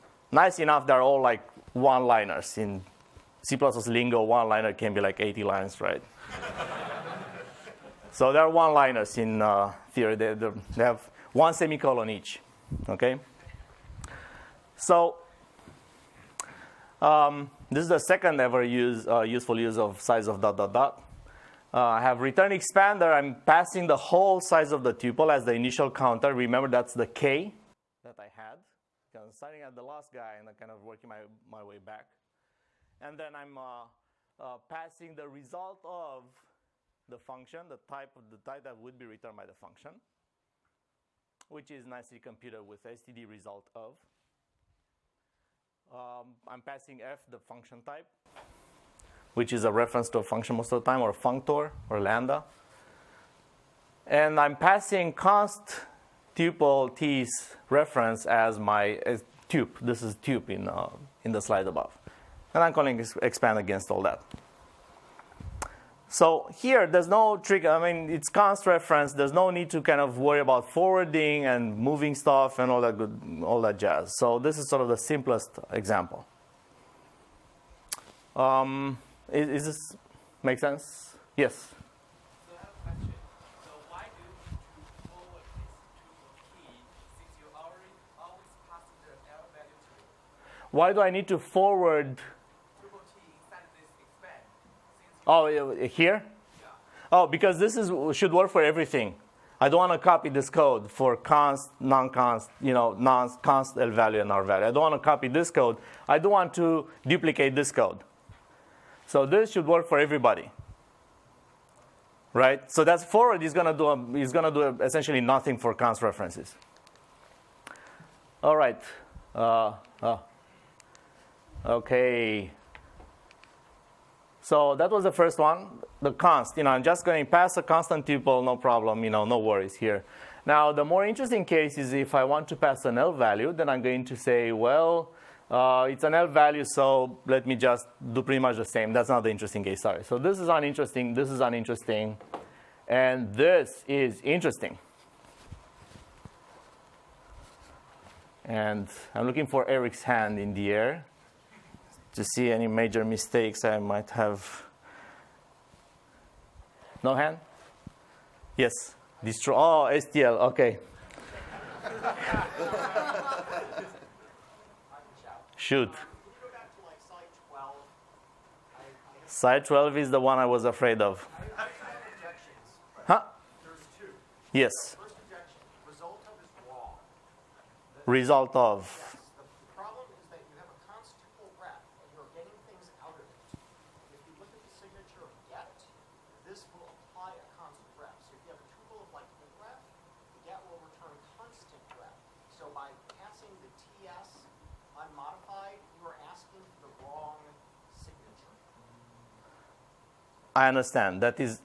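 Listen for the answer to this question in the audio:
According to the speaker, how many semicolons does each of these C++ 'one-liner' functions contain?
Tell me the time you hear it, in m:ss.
0:11.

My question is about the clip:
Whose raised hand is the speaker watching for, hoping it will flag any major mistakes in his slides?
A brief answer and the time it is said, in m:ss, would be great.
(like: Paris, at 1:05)
Eric, at 2:29.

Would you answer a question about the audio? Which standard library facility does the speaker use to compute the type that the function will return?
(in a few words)
std result of.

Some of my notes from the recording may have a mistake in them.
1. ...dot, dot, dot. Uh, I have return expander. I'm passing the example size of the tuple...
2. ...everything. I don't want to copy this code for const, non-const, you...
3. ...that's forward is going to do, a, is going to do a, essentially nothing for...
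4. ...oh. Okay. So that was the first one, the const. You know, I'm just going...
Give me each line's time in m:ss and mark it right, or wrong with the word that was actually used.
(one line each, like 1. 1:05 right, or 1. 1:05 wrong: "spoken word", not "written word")
1. 0:20 wrong: "whole", not "example"
2. 1:38 right
3. 1:52 right
4. 2:00 right.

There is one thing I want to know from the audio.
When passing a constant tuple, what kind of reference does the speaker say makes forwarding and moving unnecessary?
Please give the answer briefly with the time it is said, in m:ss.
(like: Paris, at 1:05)
const reference, at 1:08.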